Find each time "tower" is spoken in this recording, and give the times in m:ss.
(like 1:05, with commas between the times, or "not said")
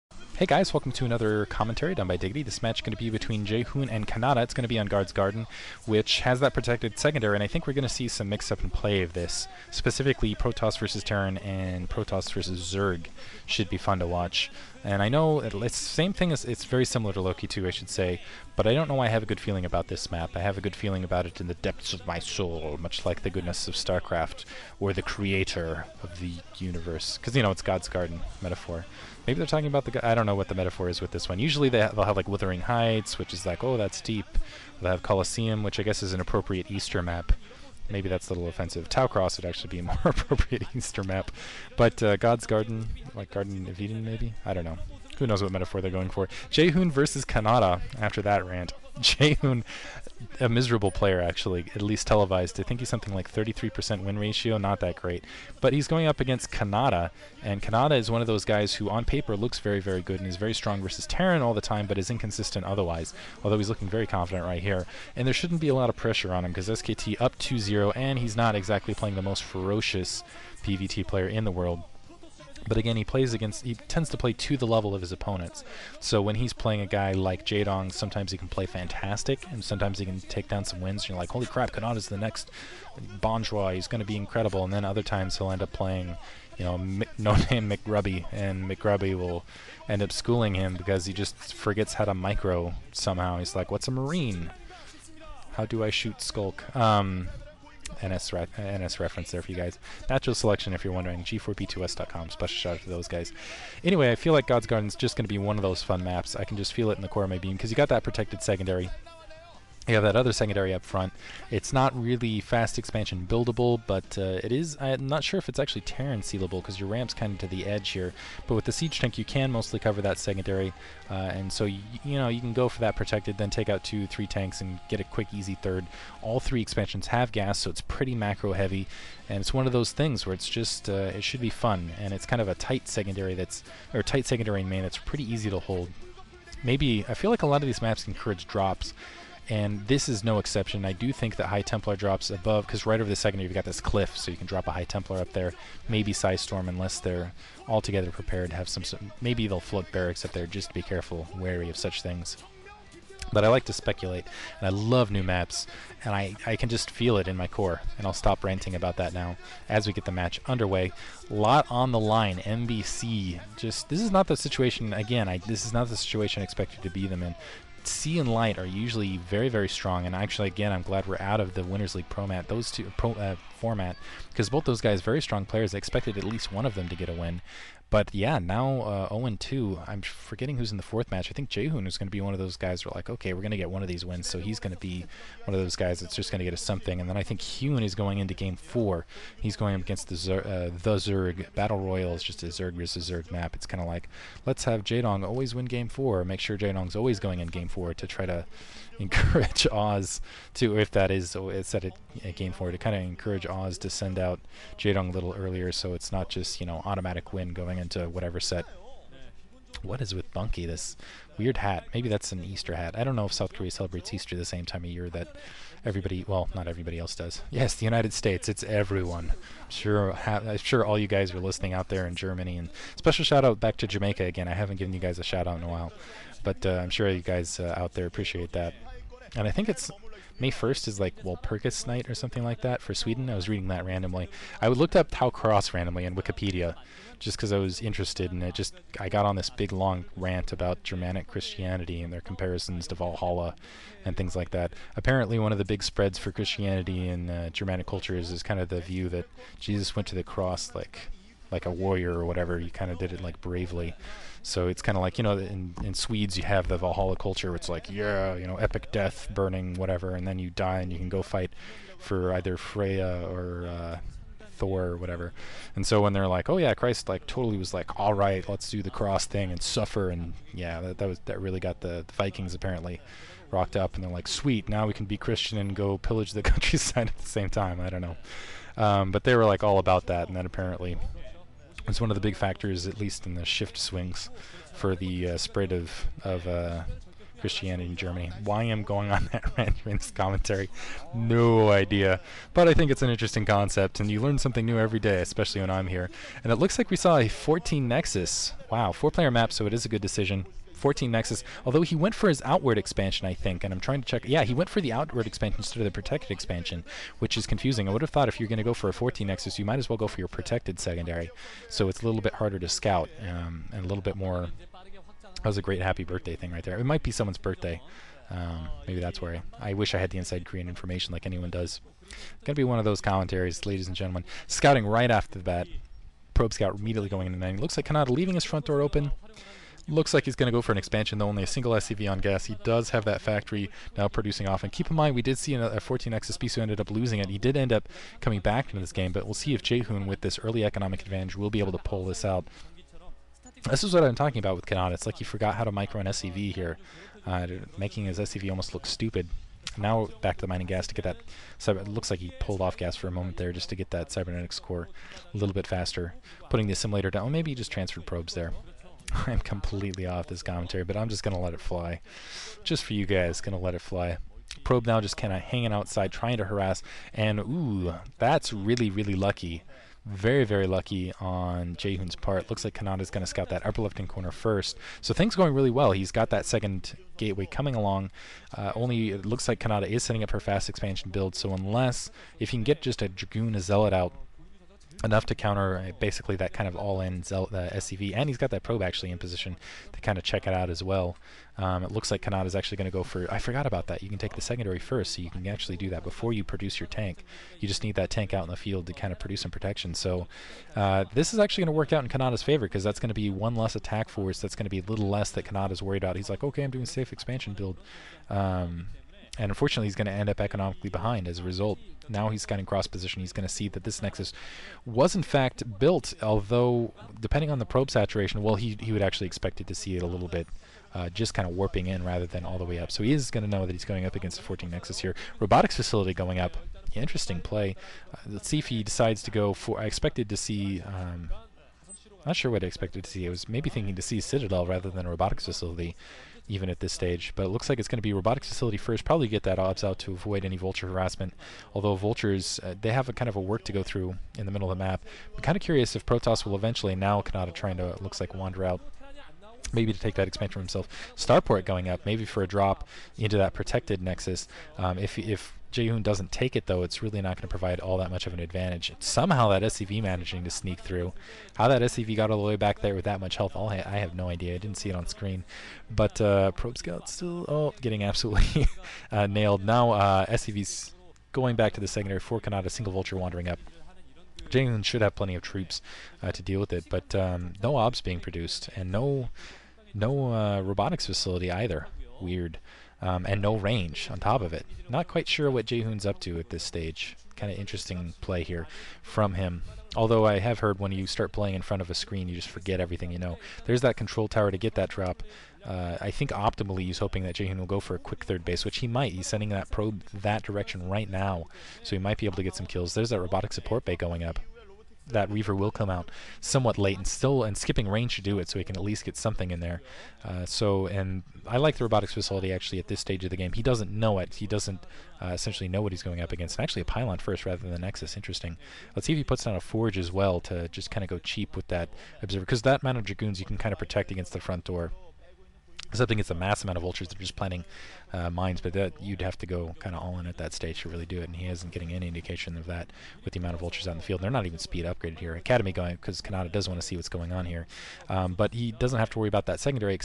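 8:14.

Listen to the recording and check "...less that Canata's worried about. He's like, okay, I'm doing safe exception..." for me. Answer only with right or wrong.
wrong.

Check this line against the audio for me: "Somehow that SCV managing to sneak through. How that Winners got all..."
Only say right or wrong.
wrong.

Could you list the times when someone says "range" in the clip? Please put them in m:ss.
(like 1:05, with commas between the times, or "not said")
8:03, 8:27.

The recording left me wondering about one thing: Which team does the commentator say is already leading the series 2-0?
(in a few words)
SKT.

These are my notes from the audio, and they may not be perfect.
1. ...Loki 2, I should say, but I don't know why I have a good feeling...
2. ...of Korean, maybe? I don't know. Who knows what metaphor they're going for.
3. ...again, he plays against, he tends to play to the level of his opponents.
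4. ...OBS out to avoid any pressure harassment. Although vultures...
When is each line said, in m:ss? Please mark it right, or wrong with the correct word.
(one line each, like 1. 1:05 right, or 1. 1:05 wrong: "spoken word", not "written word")
1. 0:17 right
2. 0:43 wrong: "Eden", not "Korean"
3. 1:12 right
4. 7:19 wrong: "vulture", not "pressure".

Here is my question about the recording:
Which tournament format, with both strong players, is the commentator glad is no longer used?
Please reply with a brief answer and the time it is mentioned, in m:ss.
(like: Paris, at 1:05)
Winners League, at 2:51.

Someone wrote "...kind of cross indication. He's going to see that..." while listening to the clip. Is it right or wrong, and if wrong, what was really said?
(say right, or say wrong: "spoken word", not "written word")
wrong: "position", not "indication".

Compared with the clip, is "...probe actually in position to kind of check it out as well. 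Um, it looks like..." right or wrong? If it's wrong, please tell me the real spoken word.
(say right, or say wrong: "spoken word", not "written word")
right.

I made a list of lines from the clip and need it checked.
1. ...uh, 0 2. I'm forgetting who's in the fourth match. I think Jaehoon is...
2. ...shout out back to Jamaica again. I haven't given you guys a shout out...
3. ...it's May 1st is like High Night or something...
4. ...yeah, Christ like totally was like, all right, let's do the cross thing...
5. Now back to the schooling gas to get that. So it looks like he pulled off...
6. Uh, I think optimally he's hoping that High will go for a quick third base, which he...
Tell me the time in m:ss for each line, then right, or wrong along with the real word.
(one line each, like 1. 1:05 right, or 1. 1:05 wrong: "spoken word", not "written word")
1. 2:58 right
2. 3:43 right
3. 3:49 wrong: "Walpurgis", not "High"
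4. 4:26 right
5. 5:49 wrong: "mining", not "schooling"
6. 8:15 wrong: "Jaehoon", not "High".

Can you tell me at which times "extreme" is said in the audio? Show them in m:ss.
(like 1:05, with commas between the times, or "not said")
not said.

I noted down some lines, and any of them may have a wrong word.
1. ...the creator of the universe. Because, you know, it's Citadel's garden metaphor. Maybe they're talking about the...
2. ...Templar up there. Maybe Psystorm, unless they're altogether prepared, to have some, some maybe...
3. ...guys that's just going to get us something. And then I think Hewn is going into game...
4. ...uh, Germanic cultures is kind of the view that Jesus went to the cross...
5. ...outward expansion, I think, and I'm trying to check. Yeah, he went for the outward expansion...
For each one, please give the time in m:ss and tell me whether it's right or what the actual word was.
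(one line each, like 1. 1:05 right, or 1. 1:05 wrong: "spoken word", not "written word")
1. 0:24 wrong: "God", not "Citadel"
2. 2:24 right
3. 3:05 right
4. 4:07 right
5. 5:02 right.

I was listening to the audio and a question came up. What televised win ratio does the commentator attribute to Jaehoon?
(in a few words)
33%.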